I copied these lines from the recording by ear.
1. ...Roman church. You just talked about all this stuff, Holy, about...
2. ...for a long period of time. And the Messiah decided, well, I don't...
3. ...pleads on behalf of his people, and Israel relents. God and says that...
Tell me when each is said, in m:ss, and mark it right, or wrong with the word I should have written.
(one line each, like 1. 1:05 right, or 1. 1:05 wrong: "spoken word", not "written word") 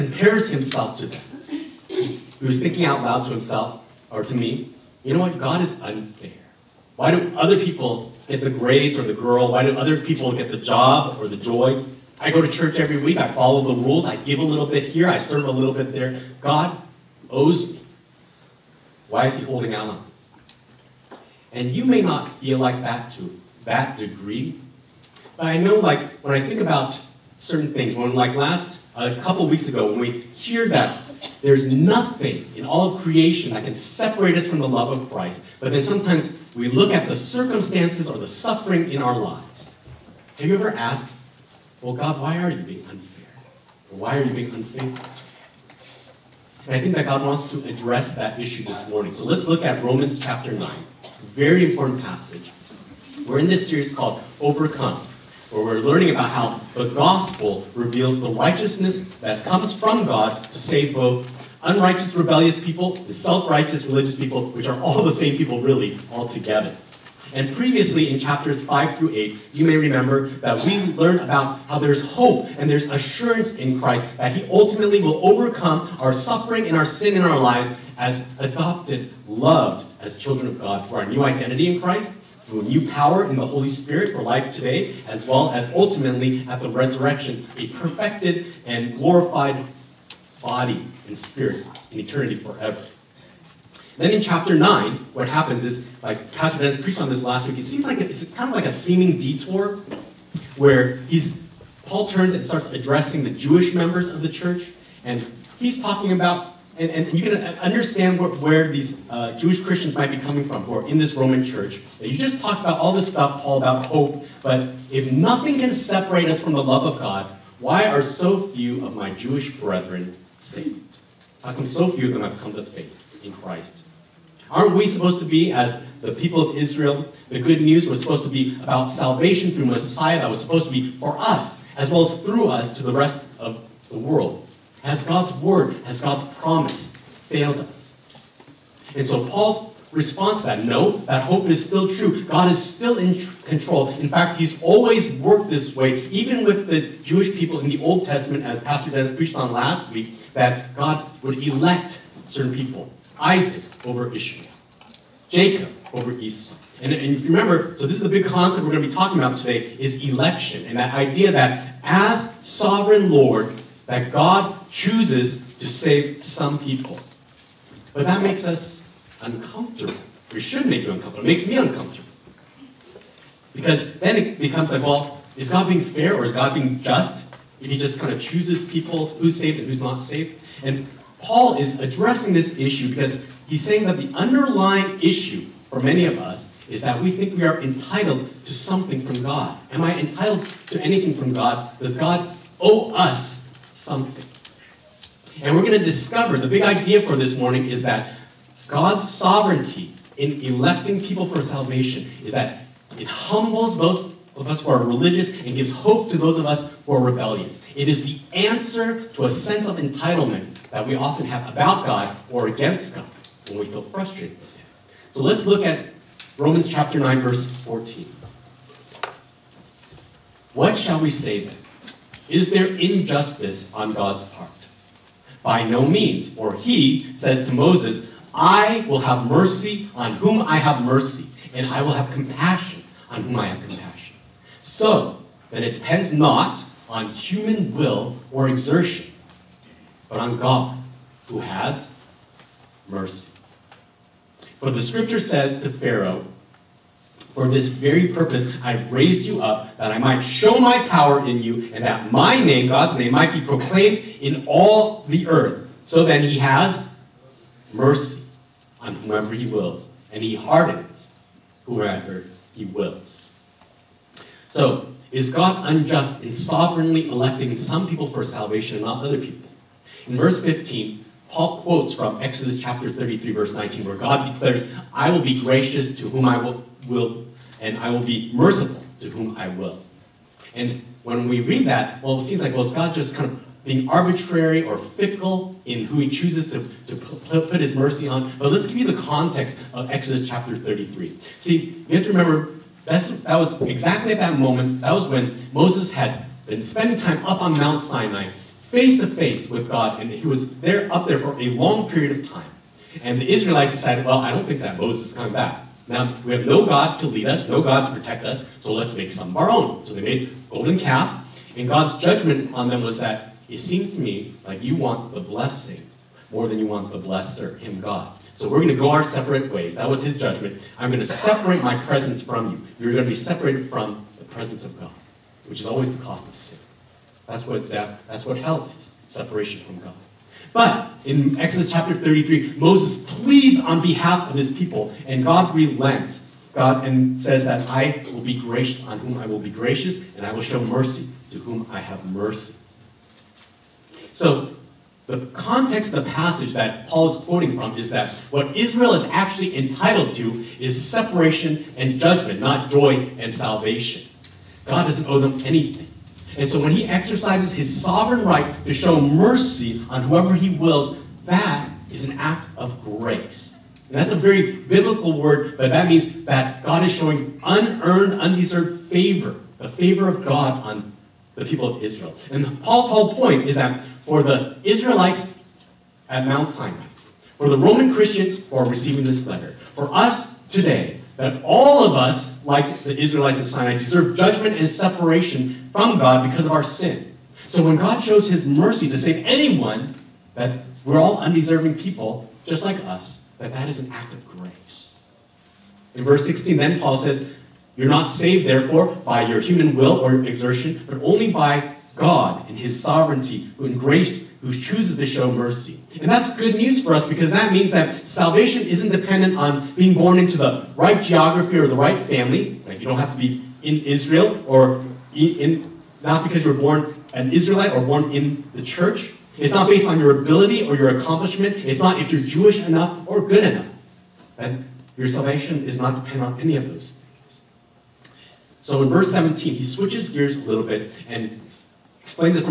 1. 1:51 wrong: "Paul", not "Holy"
2. 5:01 wrong: "Israelites", not "Messiah"
3. 5:33 wrong: "God", not "Israel".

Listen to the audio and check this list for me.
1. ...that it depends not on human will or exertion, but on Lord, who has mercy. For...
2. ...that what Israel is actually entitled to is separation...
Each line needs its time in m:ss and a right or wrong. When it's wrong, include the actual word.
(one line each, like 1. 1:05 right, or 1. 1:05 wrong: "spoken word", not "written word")
1. 3:55 wrong: "God", not "Lord"
2. 5:47 right.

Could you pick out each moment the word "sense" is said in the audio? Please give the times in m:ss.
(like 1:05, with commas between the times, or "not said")
3:29.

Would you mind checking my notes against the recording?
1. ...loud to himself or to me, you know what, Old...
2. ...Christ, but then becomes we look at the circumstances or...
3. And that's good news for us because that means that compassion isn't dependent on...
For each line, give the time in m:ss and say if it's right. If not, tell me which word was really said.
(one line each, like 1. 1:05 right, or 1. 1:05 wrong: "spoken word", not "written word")
1. 0:03 wrong: "God", not "Old"
2. 0:35 wrong: "sometimes", not "becomes"
3. 6:45 wrong: "salvation", not "compassion".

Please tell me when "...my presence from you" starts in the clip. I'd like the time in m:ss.
5:21.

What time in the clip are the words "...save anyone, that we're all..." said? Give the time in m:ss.
6:28.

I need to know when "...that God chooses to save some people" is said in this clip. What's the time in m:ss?
2:43.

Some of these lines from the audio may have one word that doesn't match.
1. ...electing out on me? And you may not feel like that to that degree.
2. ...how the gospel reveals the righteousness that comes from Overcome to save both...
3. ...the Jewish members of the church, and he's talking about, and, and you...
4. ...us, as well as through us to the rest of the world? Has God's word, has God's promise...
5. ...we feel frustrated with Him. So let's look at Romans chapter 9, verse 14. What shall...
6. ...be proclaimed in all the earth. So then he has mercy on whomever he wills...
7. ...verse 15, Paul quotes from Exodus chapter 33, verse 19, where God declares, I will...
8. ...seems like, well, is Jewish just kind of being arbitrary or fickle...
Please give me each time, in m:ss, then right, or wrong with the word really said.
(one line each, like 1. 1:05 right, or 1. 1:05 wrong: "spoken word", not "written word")
1. 0:19 wrong: "holding", not "electing"
2. 0:56 wrong: "God", not "Overcome"
3. 1:43 right
4. 2:11 right
5. 3:33 right
6. 4:13 right
7. 4:30 right
8. 4:42 wrong: "God", not "Jewish".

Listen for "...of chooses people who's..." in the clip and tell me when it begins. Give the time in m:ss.
2:58.